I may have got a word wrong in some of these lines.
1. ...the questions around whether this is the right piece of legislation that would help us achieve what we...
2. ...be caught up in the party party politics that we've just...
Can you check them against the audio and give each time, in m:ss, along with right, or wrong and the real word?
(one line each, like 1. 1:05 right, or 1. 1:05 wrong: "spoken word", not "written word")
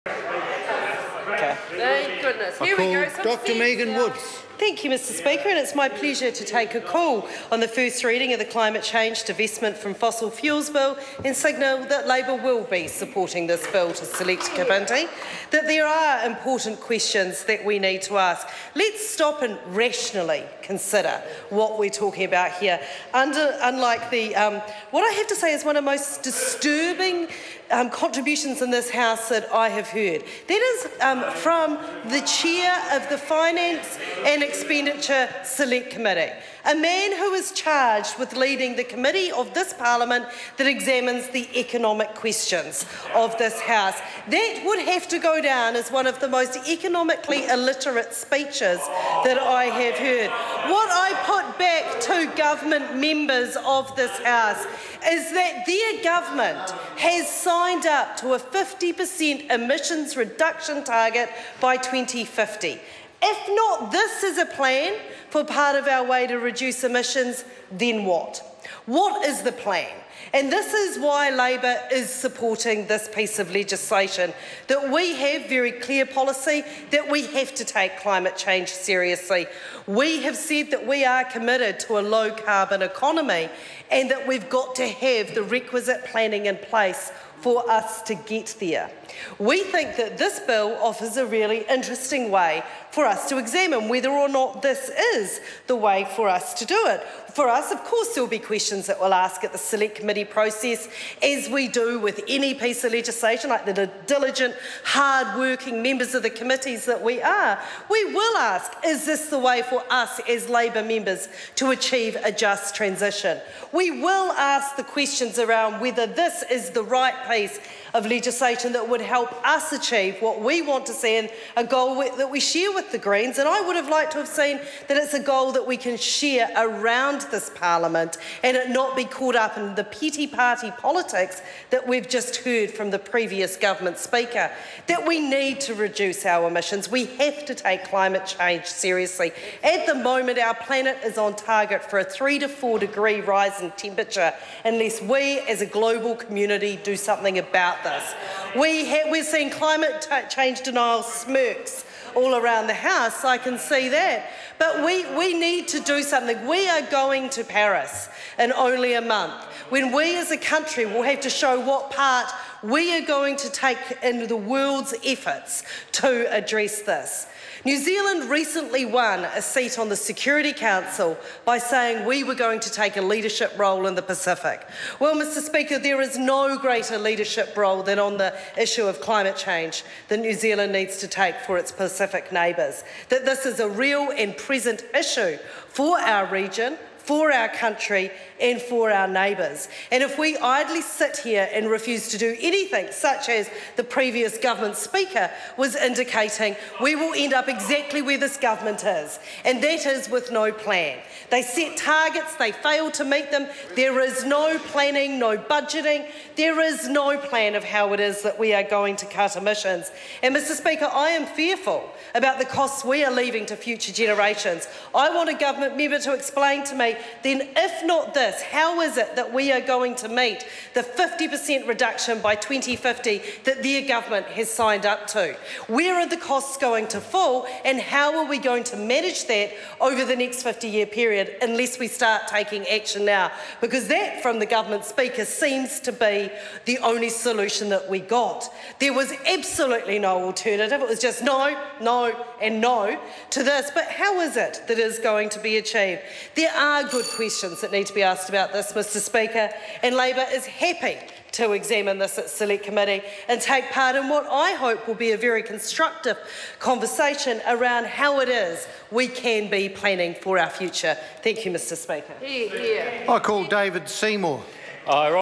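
1. 1:54 right
2. 2:08 wrong: "petty", not "party".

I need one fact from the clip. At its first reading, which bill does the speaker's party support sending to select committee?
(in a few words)
Climate Change Divestment from Fossil Fuels Bill.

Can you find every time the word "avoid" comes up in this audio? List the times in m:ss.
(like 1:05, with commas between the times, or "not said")
not said.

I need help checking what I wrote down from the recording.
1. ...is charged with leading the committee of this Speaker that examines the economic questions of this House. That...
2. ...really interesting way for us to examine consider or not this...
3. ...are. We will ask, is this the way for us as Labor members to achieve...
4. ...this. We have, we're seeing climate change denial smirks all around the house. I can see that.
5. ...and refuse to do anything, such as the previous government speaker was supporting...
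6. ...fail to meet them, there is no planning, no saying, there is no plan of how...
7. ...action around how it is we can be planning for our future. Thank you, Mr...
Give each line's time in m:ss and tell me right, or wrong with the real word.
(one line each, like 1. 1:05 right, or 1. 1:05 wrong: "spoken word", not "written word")
1. 0:37 wrong: "Parliament", not "Speaker"
2. 1:31 wrong: "whether", not "consider"
3. 1:47 right
4. 2:27 right
5. 3:11 wrong: "indicating", not "supporting"
6. 3:22 wrong: "budgeting", not "saying"
7. 4:16 wrong: "conversation", not "action".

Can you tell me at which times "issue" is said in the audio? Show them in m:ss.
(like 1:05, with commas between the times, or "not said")
2:58, 3:04.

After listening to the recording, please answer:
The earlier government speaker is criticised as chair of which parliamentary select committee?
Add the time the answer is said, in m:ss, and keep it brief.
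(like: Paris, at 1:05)
Finance and Expenditure Select Committee, at 0:33.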